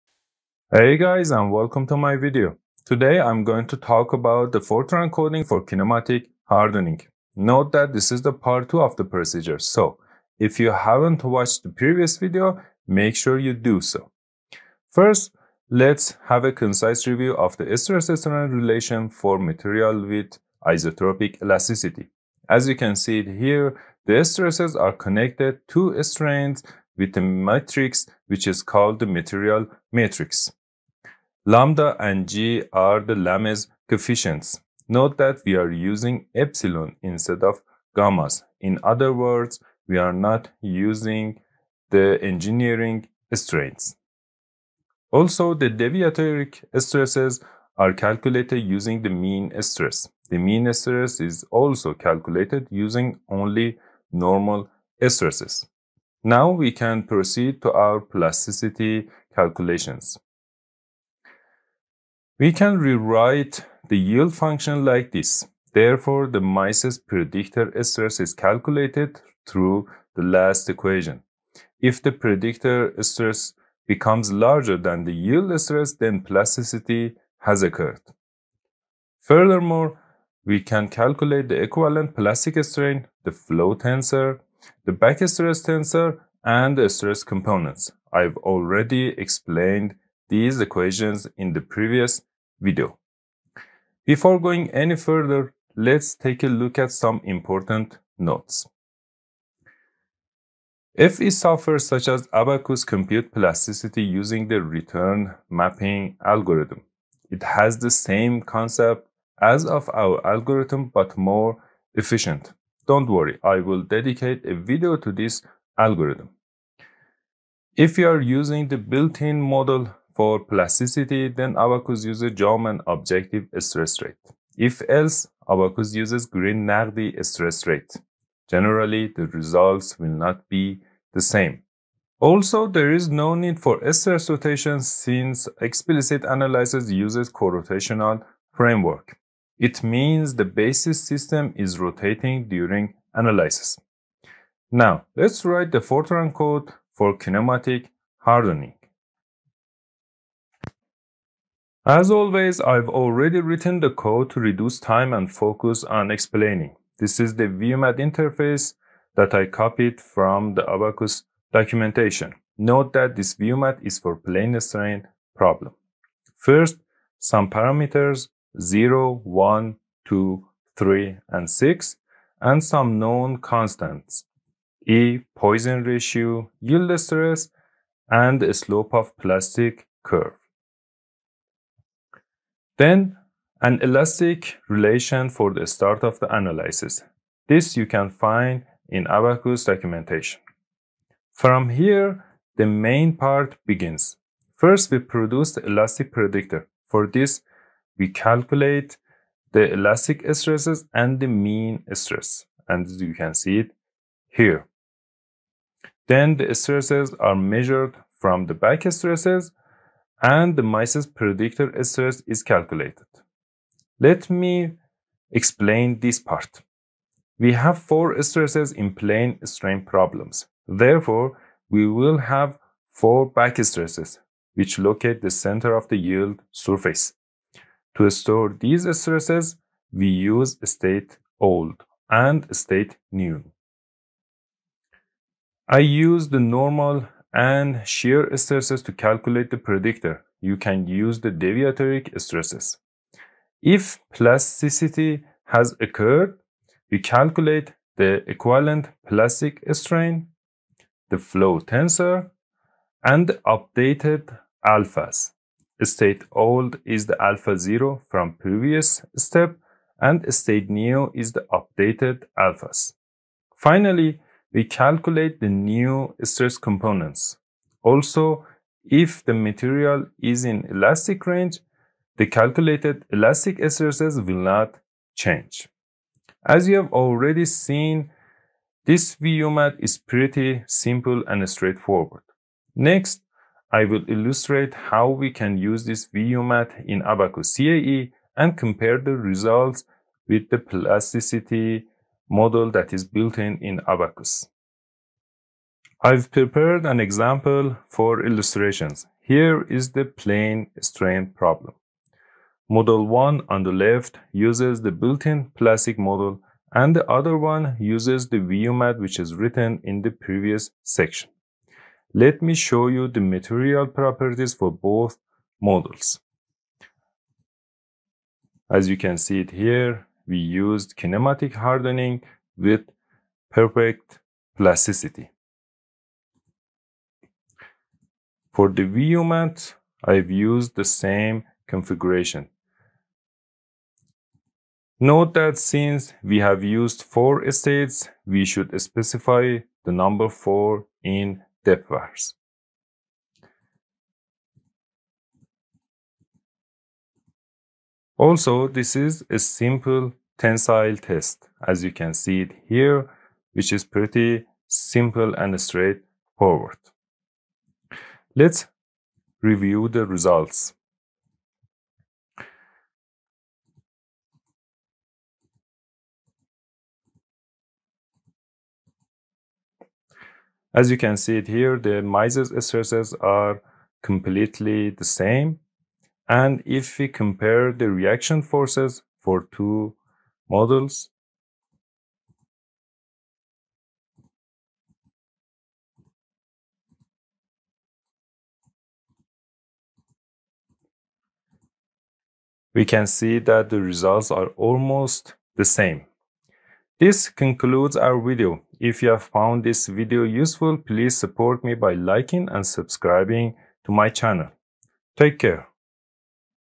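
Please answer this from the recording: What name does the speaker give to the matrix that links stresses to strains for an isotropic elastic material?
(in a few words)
material matrix.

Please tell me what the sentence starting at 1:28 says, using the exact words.
I've already explained these equations in the previous video.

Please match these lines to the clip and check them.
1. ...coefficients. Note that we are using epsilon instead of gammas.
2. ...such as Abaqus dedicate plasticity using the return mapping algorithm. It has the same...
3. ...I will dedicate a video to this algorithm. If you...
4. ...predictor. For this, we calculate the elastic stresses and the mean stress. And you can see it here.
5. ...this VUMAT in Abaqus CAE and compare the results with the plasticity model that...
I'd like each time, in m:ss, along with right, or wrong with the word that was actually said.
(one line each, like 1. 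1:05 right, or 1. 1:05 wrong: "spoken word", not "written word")
1. 0:33 right
2. 1:41 wrong: "compute", not "dedicate"
3. 1:53 right
4. 3:16 right
5. 4:45 right.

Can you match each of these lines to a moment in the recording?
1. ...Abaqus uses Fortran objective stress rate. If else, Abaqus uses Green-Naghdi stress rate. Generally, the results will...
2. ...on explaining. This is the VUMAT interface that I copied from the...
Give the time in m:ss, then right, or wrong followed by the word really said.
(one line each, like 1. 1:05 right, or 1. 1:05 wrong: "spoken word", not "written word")
1. 2:01 wrong: "Jaumann", not "Fortran"
2. 2:35 right.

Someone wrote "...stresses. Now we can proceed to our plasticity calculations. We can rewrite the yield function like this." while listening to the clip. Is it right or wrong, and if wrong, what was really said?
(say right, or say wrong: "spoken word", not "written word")
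right.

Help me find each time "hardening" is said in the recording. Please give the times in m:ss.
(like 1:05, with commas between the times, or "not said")
0:06, 2:28, 5:21.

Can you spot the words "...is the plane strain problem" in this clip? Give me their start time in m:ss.
4:59.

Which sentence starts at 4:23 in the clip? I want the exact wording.
Finally, we calculate the new stress components.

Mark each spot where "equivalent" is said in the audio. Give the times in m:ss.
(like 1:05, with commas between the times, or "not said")
1:21, 4:08.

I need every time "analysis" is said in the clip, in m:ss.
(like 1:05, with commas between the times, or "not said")
2:16, 2:23, 3:06.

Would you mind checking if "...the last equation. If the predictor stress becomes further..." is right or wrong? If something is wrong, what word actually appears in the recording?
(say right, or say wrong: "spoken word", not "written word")
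wrong: "larger", not "further".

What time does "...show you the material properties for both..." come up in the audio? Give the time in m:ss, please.
5:12.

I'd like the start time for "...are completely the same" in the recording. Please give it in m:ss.
6:13.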